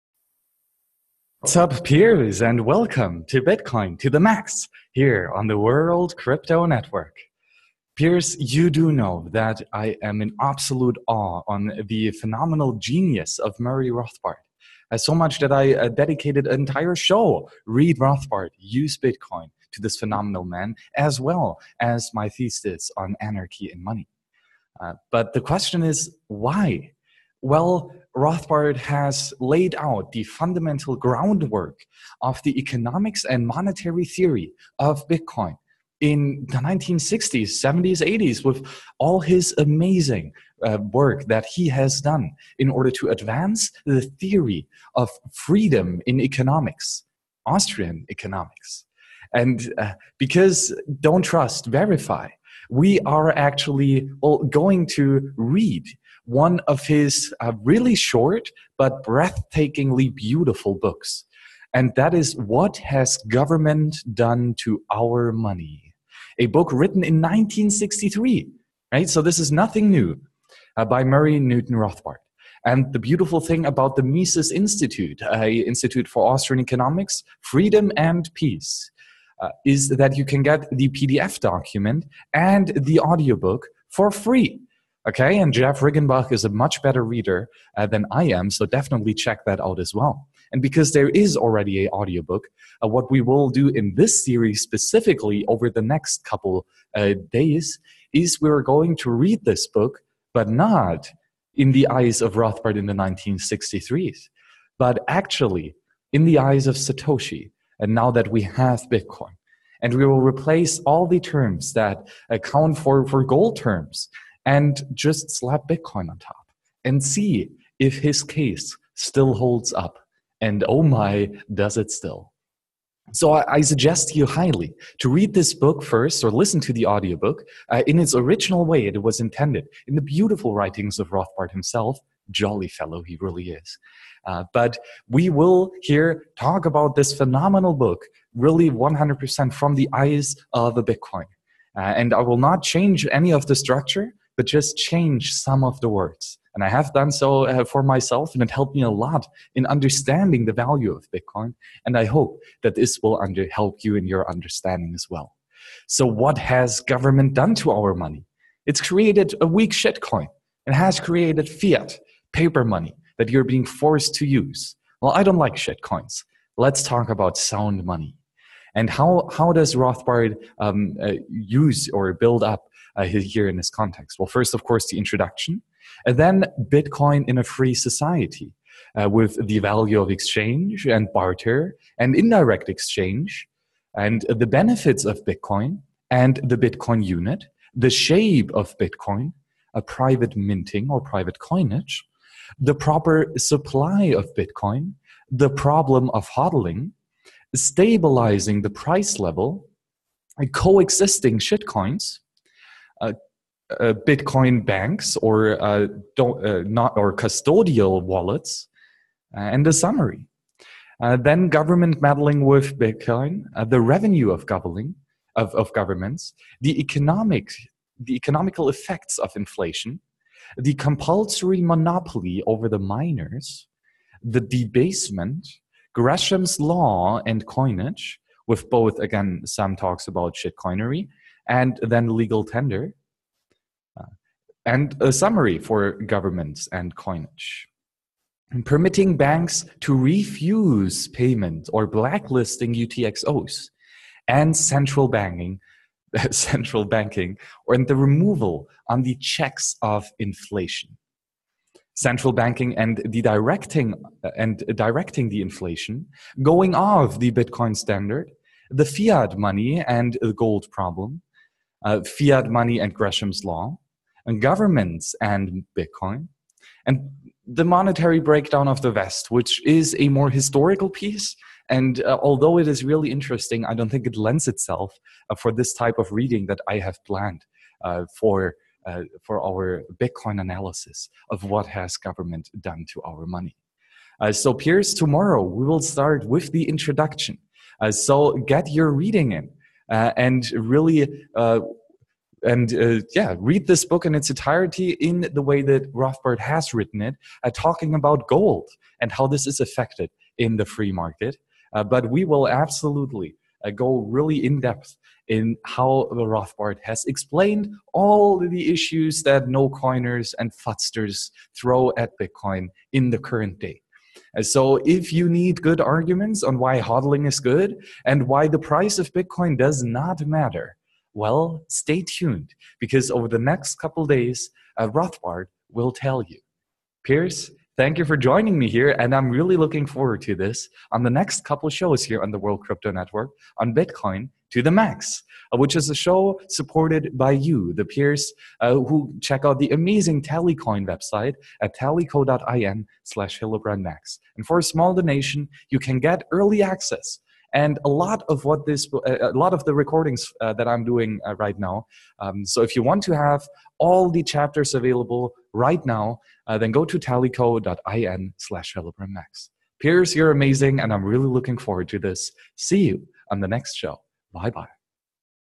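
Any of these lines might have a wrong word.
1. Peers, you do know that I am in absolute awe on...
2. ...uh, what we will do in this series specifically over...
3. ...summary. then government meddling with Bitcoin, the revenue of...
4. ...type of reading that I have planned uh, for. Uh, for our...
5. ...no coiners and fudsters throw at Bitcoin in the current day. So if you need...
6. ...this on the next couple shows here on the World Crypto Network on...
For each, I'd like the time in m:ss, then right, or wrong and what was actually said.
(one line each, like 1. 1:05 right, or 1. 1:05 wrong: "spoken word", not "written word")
1. 0:07 right
2. 1:32 right
3. 3:29 right
4. 4:35 right
5. 5:09 right
6. 5:30 right.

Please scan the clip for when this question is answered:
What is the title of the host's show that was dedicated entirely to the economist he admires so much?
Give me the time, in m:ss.
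0:17.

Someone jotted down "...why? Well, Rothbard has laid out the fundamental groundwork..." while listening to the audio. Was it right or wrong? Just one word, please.
right.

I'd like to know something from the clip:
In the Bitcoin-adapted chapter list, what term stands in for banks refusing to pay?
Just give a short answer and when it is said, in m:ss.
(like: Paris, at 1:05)
Blacklisting UTXOs, at 4:01.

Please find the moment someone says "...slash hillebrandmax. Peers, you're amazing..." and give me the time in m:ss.
5:58.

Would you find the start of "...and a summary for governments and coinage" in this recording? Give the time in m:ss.
3:54.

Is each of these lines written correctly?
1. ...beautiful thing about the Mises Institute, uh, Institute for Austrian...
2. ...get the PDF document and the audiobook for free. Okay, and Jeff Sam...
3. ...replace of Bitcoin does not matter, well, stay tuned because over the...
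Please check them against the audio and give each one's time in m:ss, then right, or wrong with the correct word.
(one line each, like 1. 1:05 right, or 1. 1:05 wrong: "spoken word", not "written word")
1. 1:12 right
2. 1:20 wrong: "Riggenbach", not "Sam"
3. 5:18 wrong: "price", not "replace".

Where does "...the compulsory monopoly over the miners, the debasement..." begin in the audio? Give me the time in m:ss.
3:40.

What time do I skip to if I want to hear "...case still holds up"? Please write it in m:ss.
1:58.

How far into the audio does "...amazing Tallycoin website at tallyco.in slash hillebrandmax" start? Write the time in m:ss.
5:39.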